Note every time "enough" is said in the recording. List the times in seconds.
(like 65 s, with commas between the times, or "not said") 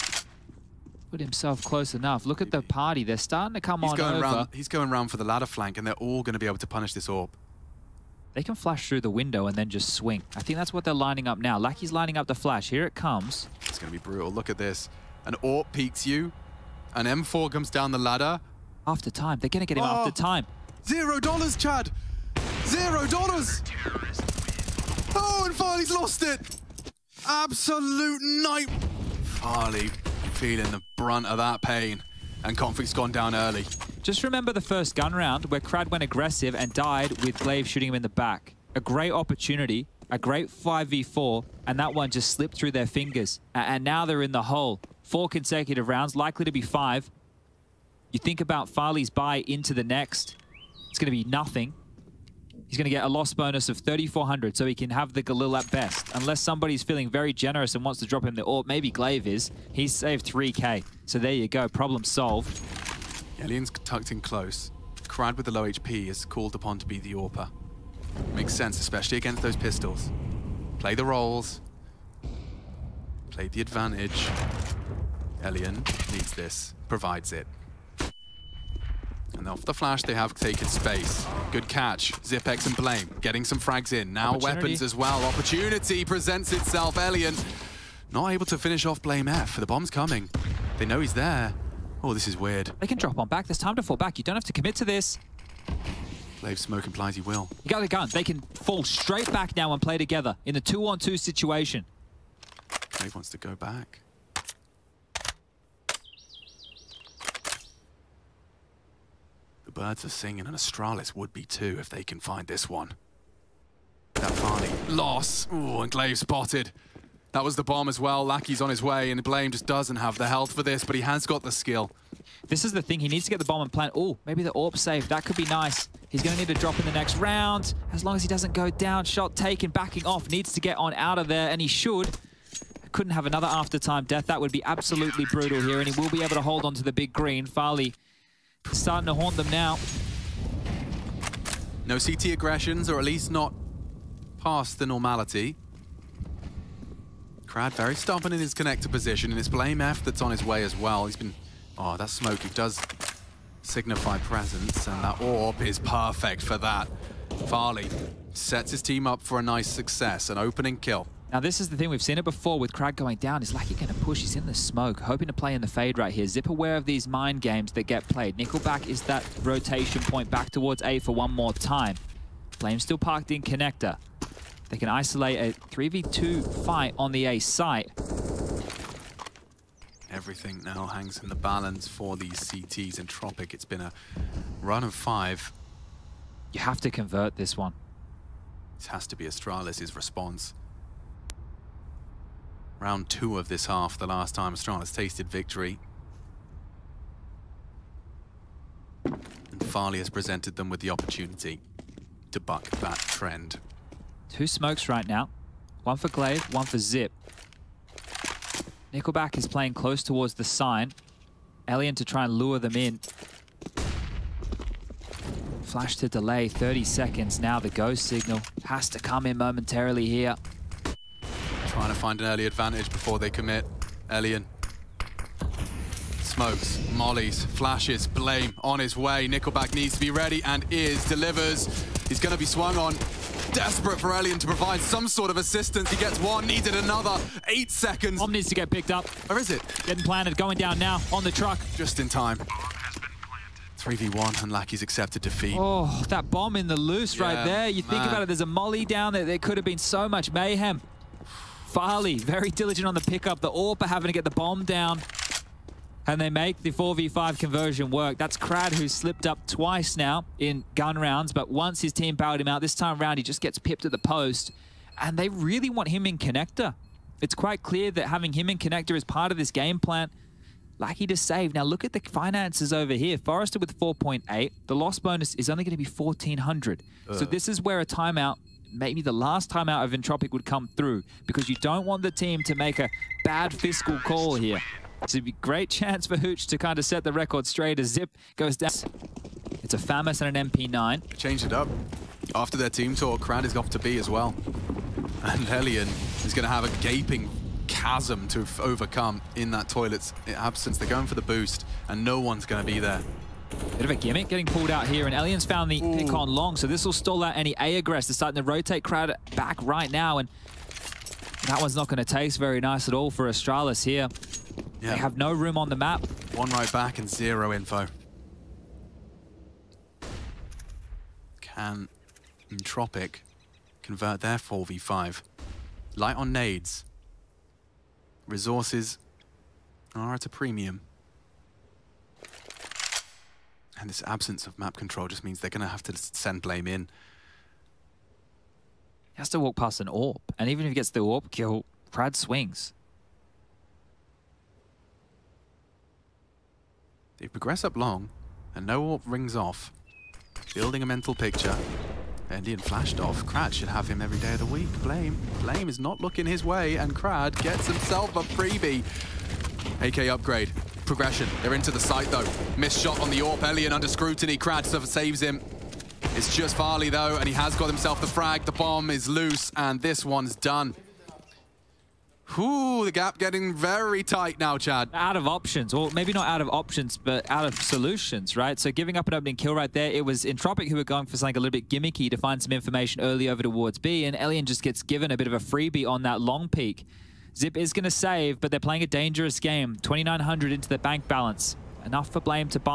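1 s, 391 s.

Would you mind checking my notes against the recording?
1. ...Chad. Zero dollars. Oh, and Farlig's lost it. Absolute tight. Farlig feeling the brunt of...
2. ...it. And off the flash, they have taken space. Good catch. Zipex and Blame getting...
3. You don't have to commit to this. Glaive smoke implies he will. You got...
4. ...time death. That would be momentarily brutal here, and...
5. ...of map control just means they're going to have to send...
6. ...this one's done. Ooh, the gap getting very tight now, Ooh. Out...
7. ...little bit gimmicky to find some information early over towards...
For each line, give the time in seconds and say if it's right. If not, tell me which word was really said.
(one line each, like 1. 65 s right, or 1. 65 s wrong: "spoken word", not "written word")
1. 21 s wrong: "night", not "tight"
2. 77 s right
3. 94 s right
4. 133 s wrong: "absolutely", not "momentarily"
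5. 334 s right
6. 369 s wrong: "Chad", not "Ooh"
7. 381 s right.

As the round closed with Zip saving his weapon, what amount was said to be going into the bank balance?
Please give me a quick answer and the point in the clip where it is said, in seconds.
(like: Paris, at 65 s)
2,900, at 389 s.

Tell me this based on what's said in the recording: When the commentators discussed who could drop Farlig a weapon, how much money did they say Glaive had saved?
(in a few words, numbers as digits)
3k.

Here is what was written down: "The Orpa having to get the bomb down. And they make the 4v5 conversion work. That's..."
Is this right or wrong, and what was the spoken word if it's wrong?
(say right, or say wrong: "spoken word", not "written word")
right.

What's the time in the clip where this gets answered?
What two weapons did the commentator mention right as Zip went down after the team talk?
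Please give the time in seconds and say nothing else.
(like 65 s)
289 s.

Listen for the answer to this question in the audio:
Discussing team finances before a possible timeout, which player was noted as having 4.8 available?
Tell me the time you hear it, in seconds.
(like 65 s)
273 s.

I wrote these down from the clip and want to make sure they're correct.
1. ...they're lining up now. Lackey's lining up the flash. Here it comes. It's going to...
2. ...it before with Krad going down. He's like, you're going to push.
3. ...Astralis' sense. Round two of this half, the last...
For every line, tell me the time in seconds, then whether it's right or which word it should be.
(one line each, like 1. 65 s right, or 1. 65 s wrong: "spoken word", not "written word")
1. 10 s right
2. 162 s right
3. 189 s wrong: "response", not "sense".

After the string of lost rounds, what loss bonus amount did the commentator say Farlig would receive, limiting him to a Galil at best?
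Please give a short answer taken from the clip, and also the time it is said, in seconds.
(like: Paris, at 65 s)
3,400, at 53 s.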